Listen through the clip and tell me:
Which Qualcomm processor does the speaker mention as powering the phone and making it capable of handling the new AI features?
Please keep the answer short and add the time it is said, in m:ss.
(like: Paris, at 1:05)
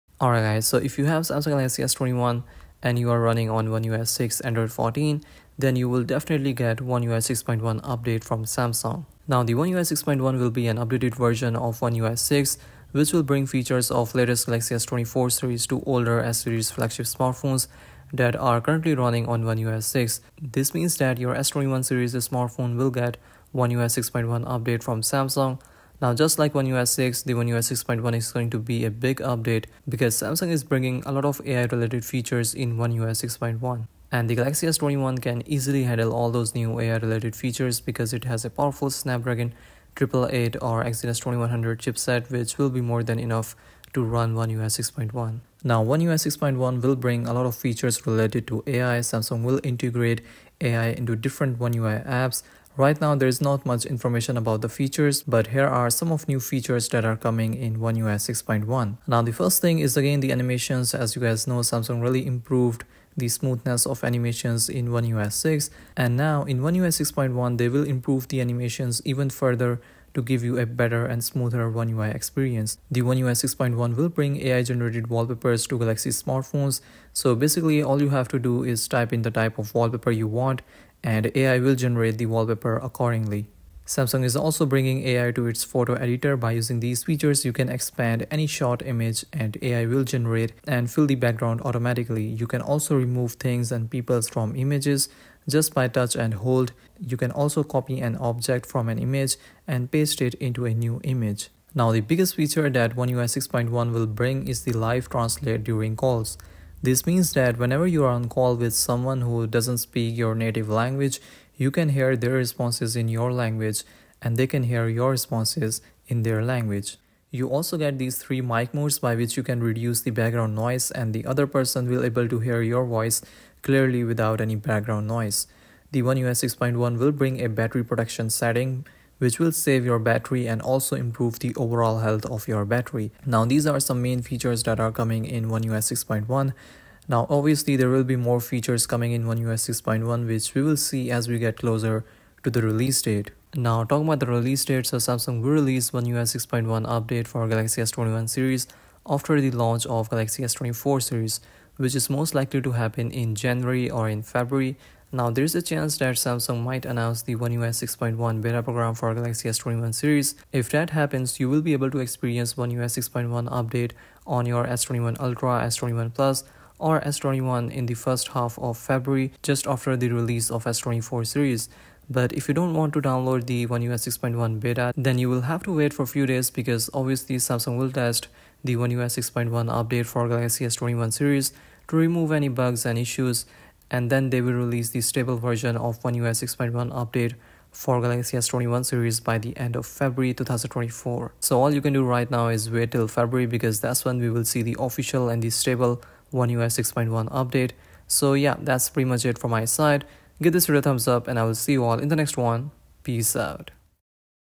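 Snapdragon 888, at 0:38.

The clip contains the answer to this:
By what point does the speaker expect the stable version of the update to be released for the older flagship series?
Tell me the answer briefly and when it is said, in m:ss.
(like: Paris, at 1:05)
End of February 2024, at 3:09.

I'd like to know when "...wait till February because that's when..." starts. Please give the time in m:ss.
3:12.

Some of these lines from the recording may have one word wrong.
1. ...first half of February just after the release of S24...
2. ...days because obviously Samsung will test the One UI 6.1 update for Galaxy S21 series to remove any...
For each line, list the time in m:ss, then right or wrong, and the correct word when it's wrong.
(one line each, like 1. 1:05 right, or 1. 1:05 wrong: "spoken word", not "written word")
1. 2:47 right
2. 2:56 right.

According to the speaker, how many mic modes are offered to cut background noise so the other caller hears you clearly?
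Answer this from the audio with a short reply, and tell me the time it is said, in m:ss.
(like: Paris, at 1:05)
3, at 1:58.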